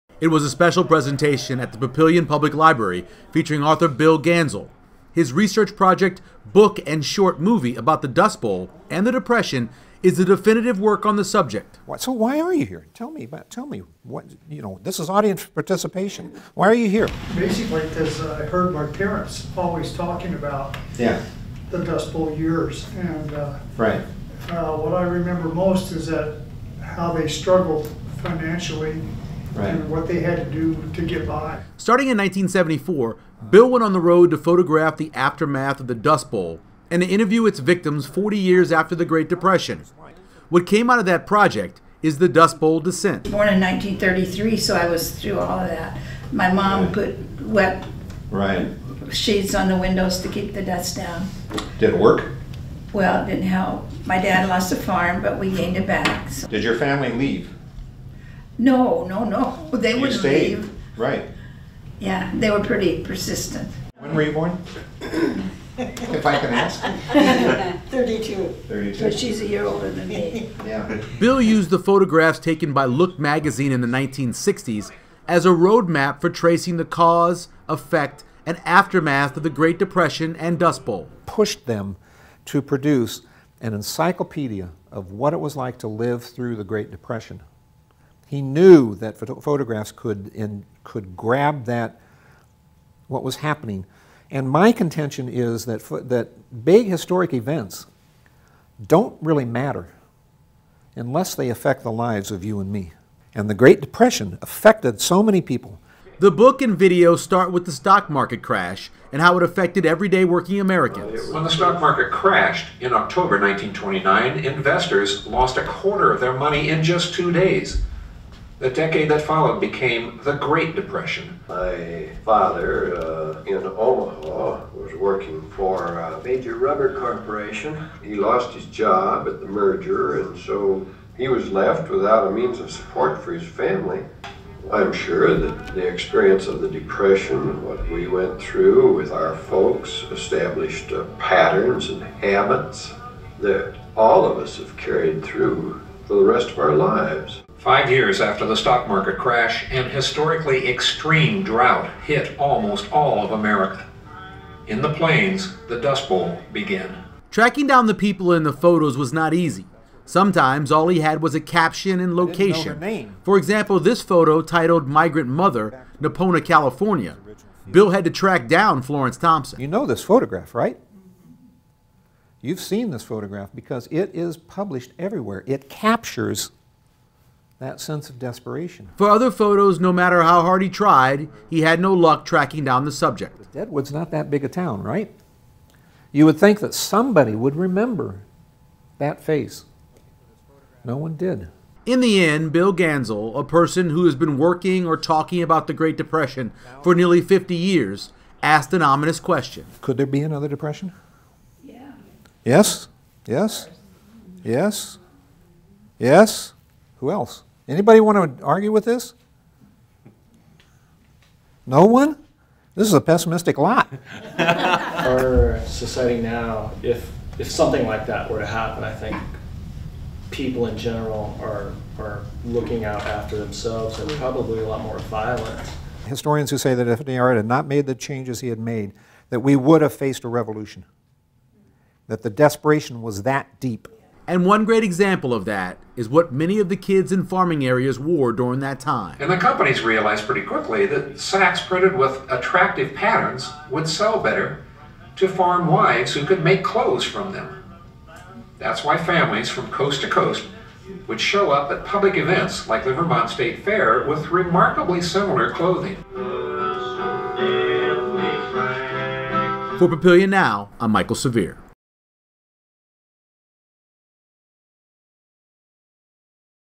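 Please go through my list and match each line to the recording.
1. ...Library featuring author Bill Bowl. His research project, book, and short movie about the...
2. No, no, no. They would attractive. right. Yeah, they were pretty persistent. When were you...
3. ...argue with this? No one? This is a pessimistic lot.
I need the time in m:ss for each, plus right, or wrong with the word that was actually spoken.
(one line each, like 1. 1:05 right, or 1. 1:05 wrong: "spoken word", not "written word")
1. 0:02 wrong: "Ganzel", not "Bowl"
2. 0:58 wrong: "leave", not "attractive"
3. 3:28 right.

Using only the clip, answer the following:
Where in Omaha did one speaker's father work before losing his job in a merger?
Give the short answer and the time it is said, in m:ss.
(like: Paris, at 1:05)
A major rubber corporation, at 2:06.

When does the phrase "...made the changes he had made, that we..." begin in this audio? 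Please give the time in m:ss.
3:47.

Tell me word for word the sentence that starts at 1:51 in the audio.
When the stock market crashed in October 1929, investors lost a quarter of their money in just two days.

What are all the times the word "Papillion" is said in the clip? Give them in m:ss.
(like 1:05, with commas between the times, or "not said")
0:01, 4:19.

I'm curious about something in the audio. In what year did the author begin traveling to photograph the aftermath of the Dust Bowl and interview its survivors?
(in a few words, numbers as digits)
1974.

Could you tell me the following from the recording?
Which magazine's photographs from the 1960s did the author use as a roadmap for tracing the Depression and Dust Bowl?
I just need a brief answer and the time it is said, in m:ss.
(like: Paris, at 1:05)
Look, at 1:12.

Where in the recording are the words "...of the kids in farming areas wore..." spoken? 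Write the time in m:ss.
3:56.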